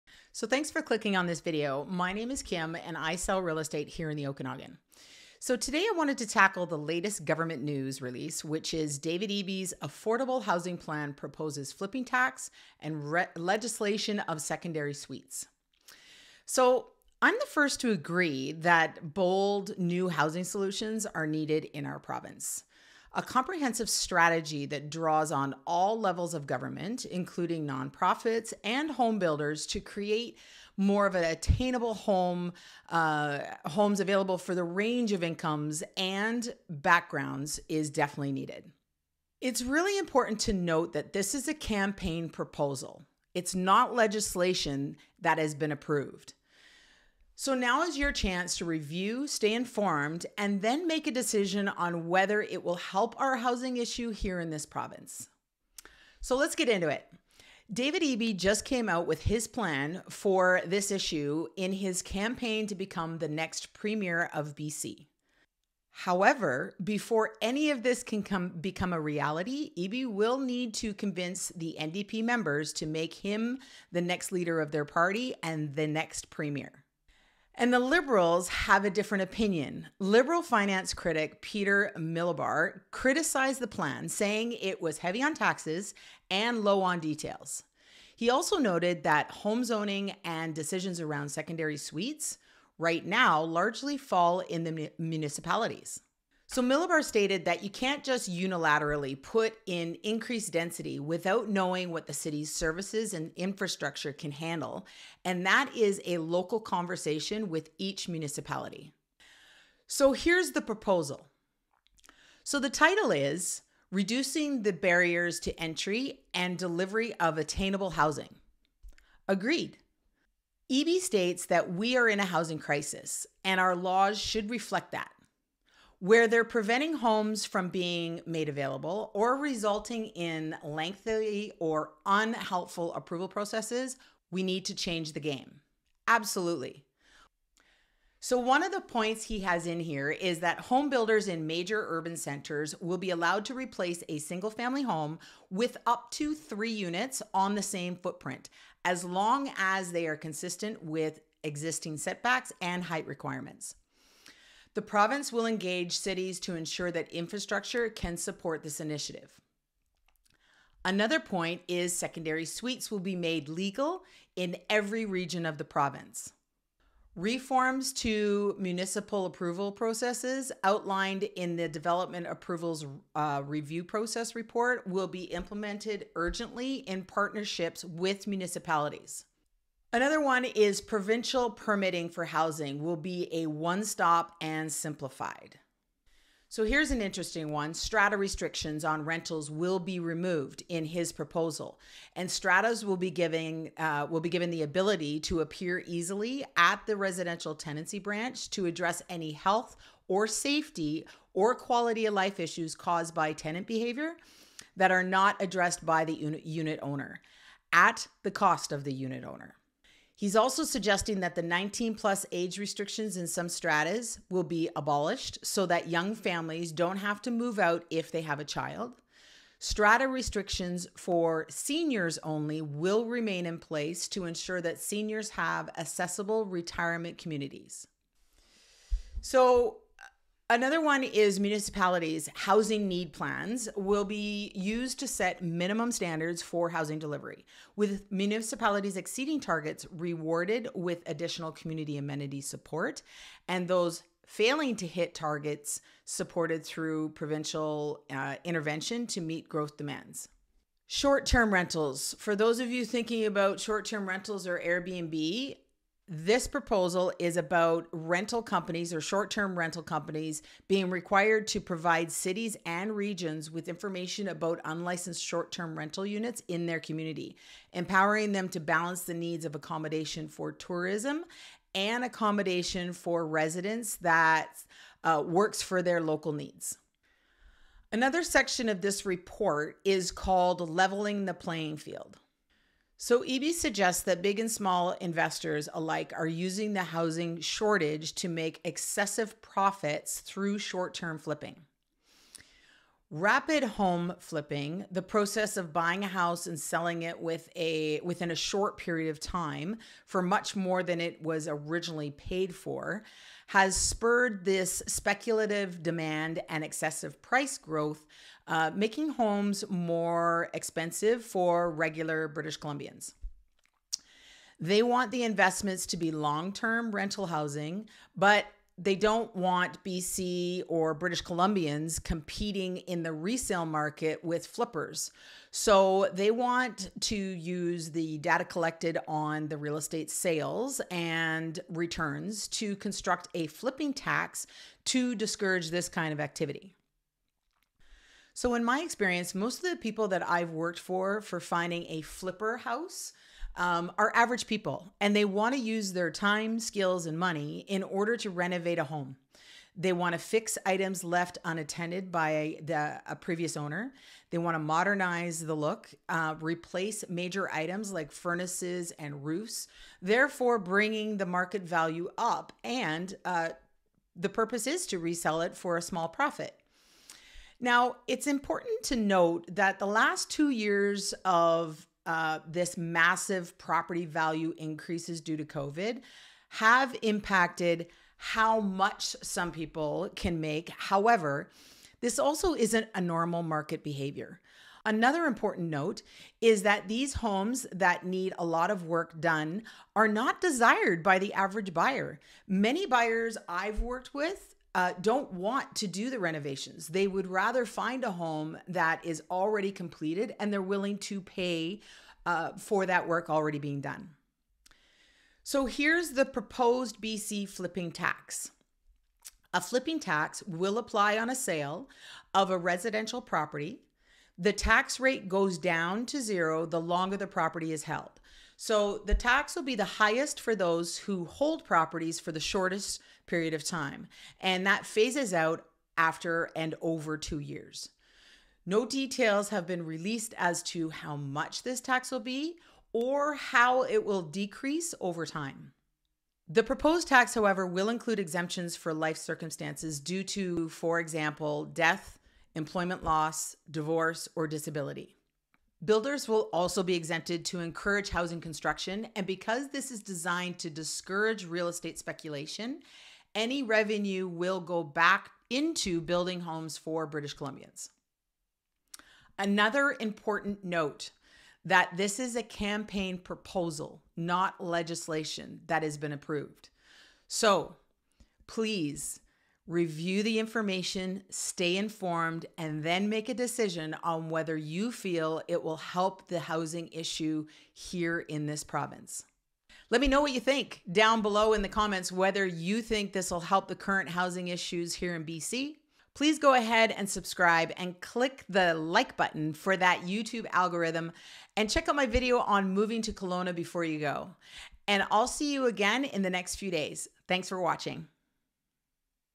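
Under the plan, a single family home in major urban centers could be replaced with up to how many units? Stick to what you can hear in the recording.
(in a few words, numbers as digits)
3.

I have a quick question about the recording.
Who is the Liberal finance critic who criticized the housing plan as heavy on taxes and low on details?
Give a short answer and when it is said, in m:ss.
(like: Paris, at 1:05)
Peter Milobar, at 1:21.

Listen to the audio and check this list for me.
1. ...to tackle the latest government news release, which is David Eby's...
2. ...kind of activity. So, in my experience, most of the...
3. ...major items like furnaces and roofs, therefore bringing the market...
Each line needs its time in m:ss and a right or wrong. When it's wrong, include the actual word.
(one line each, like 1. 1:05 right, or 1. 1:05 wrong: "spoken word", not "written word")
1. 0:06 right
2. 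5:35 right
3. 5:57 right.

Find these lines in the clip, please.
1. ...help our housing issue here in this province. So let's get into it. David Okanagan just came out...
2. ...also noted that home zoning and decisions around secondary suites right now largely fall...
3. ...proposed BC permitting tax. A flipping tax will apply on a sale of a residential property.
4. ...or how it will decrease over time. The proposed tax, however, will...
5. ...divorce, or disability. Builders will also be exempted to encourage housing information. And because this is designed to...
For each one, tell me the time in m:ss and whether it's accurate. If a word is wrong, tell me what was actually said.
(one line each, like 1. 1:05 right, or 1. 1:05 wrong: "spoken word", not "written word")
1. 0:52 wrong: "Eby", not "Okanagan"
2. 1:28 right
3. 6:46 wrong: "flipping", not "permitting"
4. 7:12 right
5. 7:23 wrong: "construction", not "information".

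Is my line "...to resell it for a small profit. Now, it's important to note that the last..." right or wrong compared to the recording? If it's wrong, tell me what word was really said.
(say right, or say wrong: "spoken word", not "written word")
right.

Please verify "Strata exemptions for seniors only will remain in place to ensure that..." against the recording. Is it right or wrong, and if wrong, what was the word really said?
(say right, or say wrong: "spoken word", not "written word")
wrong: "restrictions", not "exemptions".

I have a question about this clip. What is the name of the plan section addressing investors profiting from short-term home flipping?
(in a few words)
Leveling the Playing Field.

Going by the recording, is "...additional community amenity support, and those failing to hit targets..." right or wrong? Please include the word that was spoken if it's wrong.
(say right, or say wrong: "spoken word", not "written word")
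right.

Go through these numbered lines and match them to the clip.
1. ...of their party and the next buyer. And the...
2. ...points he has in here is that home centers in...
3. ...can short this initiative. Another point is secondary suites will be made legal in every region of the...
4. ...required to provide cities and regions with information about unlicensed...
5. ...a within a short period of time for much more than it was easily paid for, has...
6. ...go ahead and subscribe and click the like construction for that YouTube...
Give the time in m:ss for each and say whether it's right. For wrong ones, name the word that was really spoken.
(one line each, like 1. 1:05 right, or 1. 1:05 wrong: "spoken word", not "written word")
1. 1:14 wrong: "premier", not "buyer"
2. 2:18 wrong: "builders", not "centers"
3. 2:37 wrong: "support", not "short"
4. 4:20 right
5. 4:57 wrong: "originally", not "easily"
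6. 8:06 wrong: "button", not "construction".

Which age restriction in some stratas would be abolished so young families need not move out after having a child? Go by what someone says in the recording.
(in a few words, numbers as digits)
19 plus.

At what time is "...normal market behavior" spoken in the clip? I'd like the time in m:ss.
6:23.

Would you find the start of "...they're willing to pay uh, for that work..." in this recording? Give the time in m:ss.
6:40.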